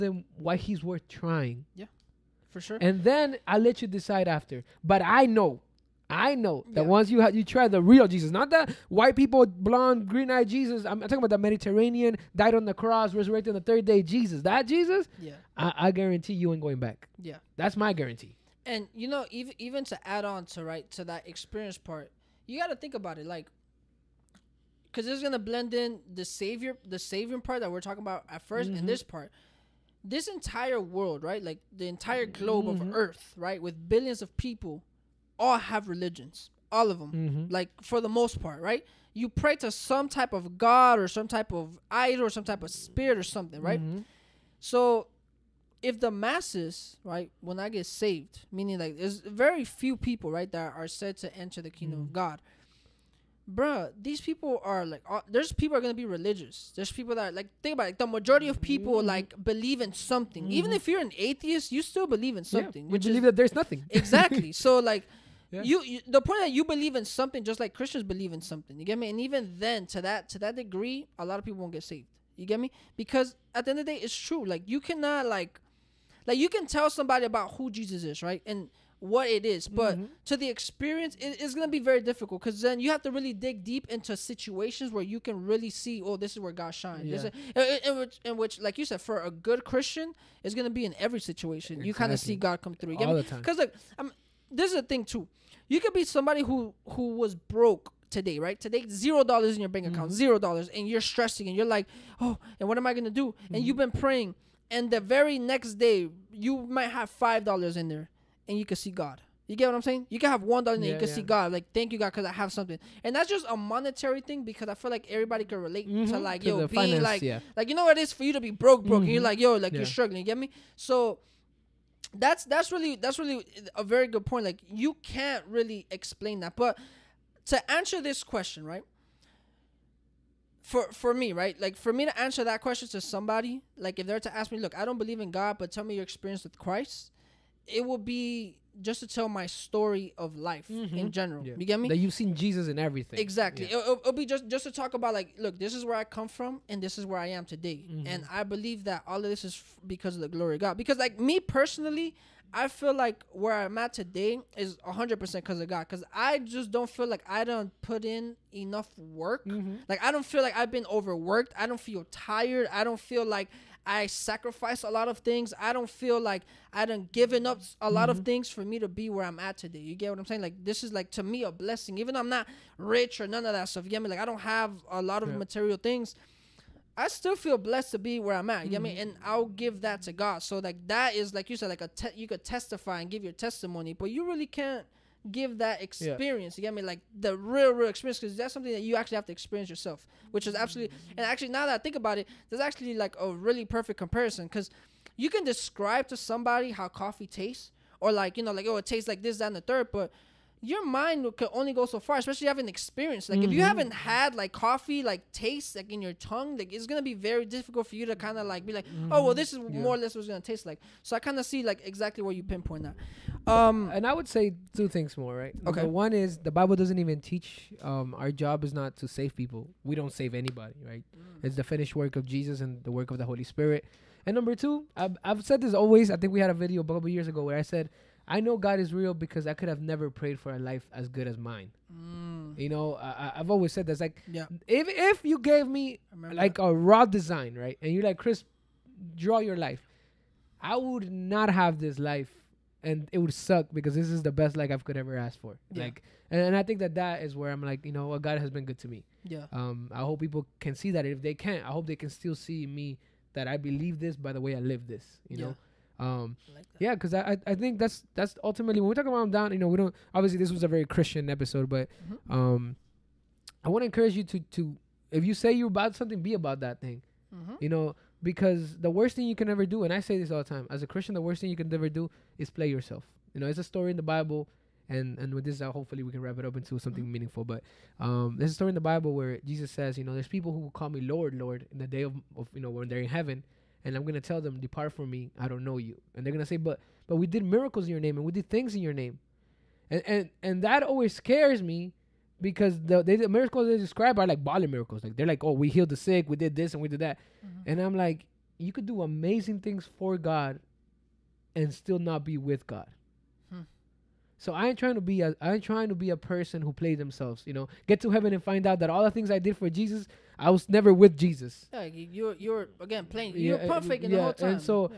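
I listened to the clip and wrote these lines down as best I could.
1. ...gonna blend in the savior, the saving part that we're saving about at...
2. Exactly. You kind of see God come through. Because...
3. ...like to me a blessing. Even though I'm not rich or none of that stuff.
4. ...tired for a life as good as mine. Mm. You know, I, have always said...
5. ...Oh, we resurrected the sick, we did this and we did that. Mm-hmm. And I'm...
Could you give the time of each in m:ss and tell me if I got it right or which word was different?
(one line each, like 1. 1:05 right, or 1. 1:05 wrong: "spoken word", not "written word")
1. 0:25 wrong: "talking", not "saving"
2. 1:31 right
3. 2:50 right
4. 3:50 wrong: "prayed", not "tired"
5. 4:55 wrong: "healed", not "resurrected".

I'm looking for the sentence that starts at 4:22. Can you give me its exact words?
um, I want to encourage you to to if you say you're about something, be about that thing.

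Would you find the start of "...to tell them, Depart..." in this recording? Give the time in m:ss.
4:44.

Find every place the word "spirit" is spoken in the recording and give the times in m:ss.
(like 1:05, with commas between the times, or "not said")
0:42, 3:43.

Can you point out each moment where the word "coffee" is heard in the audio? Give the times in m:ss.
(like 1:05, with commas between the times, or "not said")
3:16, 3:24.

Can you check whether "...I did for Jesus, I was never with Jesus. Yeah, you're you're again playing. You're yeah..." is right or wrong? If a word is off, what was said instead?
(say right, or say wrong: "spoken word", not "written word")
right.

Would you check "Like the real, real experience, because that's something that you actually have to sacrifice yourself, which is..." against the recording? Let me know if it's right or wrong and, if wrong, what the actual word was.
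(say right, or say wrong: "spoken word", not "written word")
wrong: "experience", not "sacrifice".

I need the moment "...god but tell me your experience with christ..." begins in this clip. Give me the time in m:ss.
2:15.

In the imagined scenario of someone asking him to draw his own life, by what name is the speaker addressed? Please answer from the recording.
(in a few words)
Cris.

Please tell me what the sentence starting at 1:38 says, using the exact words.
Today, zero dollars in your bank account, mm-hmm.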